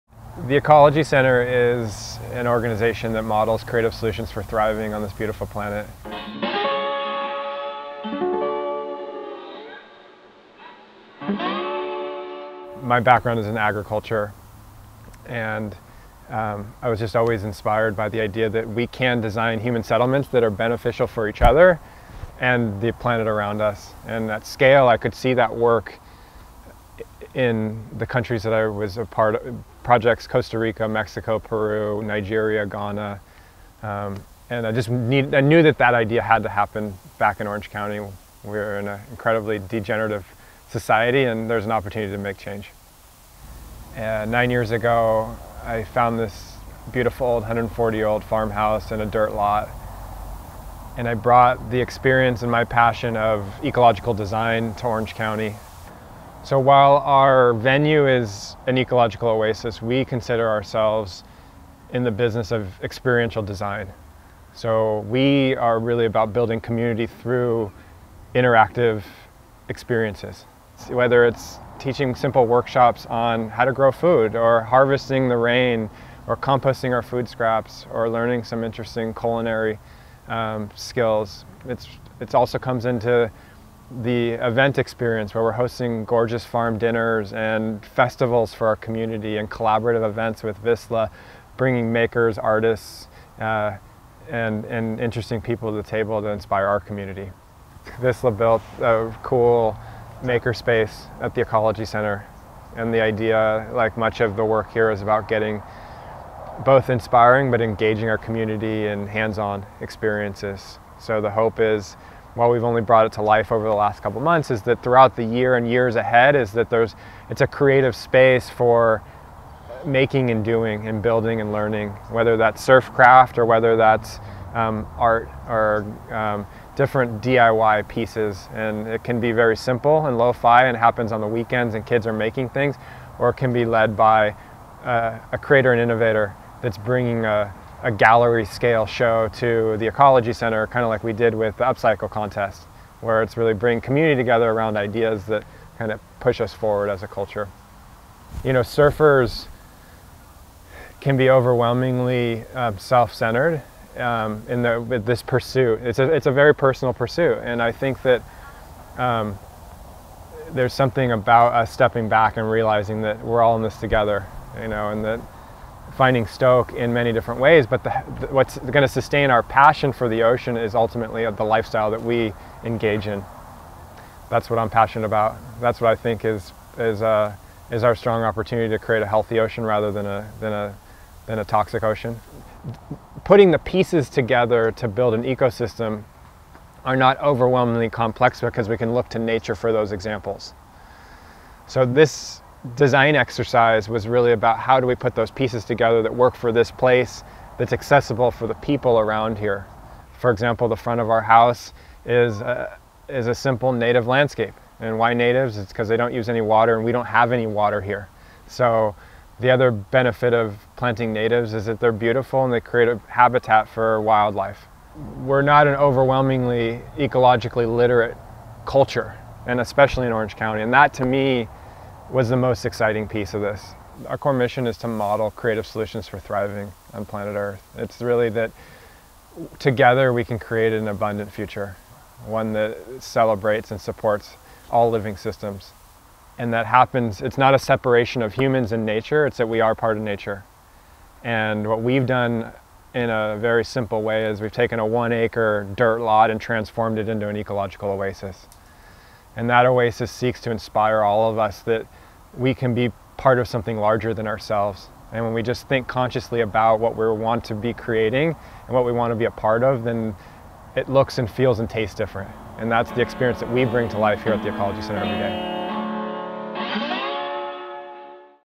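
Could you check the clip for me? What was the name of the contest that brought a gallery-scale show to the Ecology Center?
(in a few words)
Upcycle Contest.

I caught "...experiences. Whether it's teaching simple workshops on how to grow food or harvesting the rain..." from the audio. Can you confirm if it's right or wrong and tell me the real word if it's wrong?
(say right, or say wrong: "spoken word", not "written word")
right.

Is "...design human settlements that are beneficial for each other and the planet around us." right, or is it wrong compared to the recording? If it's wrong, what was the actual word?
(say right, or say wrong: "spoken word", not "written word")
right.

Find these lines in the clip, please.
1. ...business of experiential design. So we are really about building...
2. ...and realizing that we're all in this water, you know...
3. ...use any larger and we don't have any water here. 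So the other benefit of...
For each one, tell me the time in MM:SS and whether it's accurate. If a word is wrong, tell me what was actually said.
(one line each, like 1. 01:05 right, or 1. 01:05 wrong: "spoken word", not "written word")
1. 01:02 right
2. 02:42 wrong: "together", not "water"
3. 03:26 wrong: "water", not "larger".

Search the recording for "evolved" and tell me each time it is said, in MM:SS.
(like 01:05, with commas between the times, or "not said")
not said.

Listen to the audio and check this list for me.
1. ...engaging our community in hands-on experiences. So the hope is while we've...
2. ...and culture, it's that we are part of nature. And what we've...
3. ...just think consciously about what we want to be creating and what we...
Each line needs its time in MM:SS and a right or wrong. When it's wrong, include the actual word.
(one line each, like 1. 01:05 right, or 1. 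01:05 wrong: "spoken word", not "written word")
1. 01:47 right
2. 03:58 wrong: "nature", not "culture"
3. 04:15 right.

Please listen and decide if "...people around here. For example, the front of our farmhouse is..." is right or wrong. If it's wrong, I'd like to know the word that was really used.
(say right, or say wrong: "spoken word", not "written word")
wrong: "house", not "farmhouse".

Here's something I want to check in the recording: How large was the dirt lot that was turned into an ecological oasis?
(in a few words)
1 acre.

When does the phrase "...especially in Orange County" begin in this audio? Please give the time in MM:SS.
03:39.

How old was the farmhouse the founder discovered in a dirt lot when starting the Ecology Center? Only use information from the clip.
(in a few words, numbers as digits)
140 years.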